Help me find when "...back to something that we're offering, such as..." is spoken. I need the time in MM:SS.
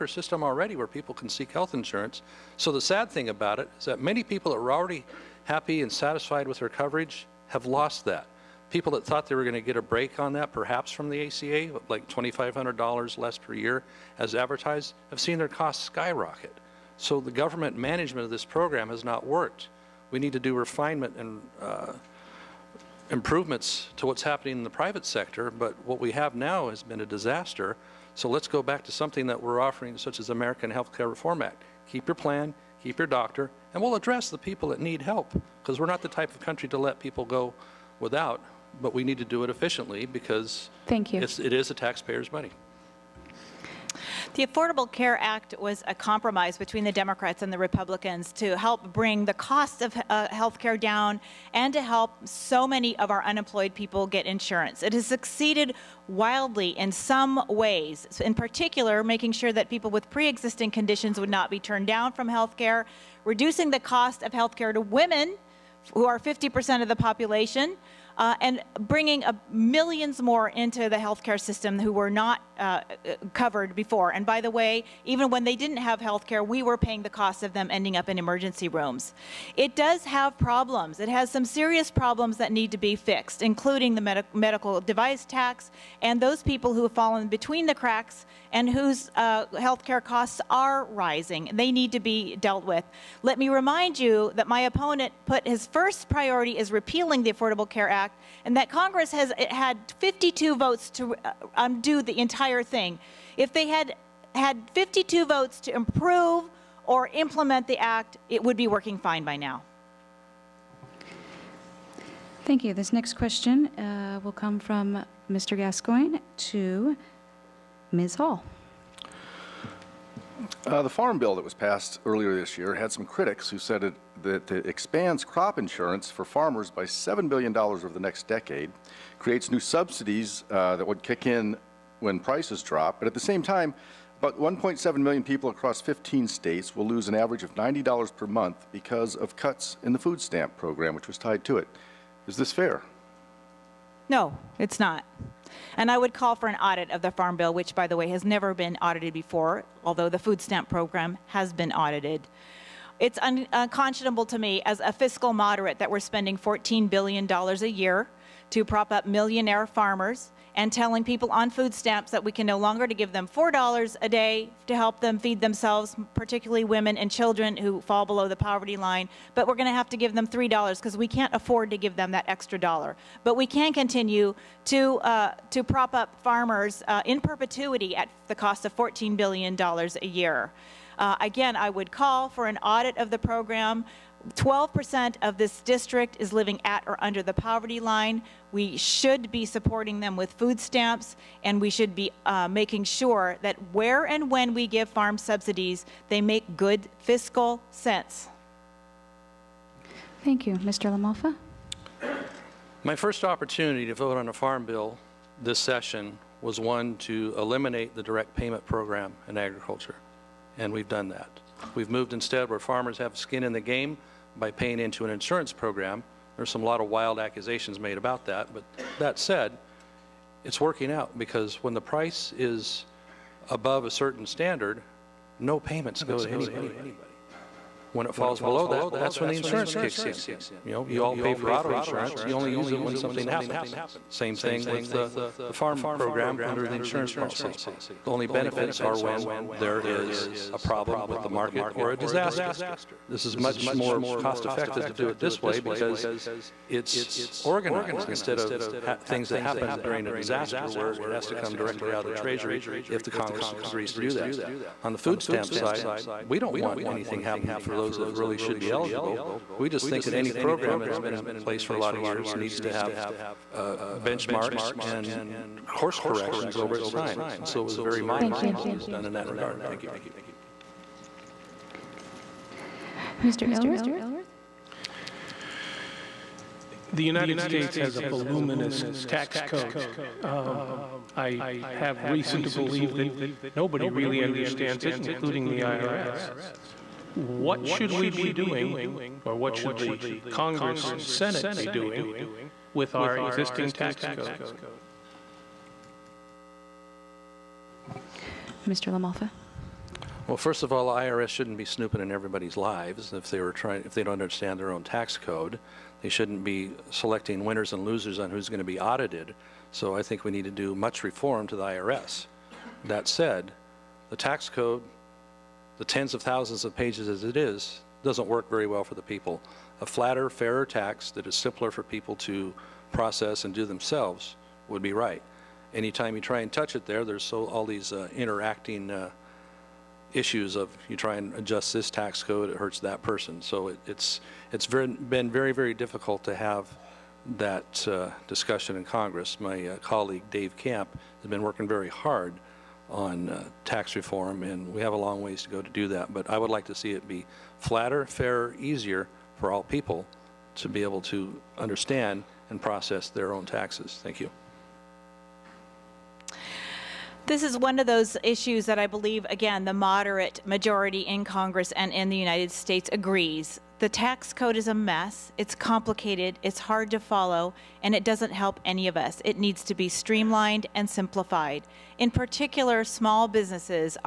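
00:28.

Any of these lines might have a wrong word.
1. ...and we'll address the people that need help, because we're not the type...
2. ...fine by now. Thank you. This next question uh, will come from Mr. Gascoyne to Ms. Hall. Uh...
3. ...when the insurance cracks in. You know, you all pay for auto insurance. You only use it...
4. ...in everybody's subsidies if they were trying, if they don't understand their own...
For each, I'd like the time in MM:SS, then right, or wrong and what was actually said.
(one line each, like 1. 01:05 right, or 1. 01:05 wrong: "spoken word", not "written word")
1. 00:33 right
2. 01:48 right
3. 03:49 wrong: "kicks", not "cracks"
4. 05:02 wrong: "lives", not "subsidies".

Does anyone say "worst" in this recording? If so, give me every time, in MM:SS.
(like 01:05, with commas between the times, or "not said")
not said.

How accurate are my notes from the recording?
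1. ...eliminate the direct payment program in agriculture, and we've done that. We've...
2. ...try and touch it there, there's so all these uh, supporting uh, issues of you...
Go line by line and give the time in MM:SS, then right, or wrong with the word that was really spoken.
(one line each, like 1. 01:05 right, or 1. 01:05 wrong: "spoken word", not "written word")
1. 03:27 right
2. 05:26 wrong: "interacting", not "supporting".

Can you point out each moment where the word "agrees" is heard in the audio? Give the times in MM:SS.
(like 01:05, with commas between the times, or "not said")
04:13, 06:02.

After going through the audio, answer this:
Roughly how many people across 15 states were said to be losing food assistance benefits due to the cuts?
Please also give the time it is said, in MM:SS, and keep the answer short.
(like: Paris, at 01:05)
1.7 million, at 02:14.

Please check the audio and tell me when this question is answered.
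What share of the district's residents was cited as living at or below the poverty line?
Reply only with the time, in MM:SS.
03:04.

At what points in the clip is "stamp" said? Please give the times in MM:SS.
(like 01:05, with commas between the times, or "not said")
02:20, 02:30, 02:41, 03:10, 04:15.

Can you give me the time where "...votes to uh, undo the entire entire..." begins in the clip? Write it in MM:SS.
01:40.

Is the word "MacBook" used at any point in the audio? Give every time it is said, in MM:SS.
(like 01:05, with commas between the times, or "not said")
not said.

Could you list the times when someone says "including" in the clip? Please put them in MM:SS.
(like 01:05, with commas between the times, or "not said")
01:23, 04:44.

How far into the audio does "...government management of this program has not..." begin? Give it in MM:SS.
00:17.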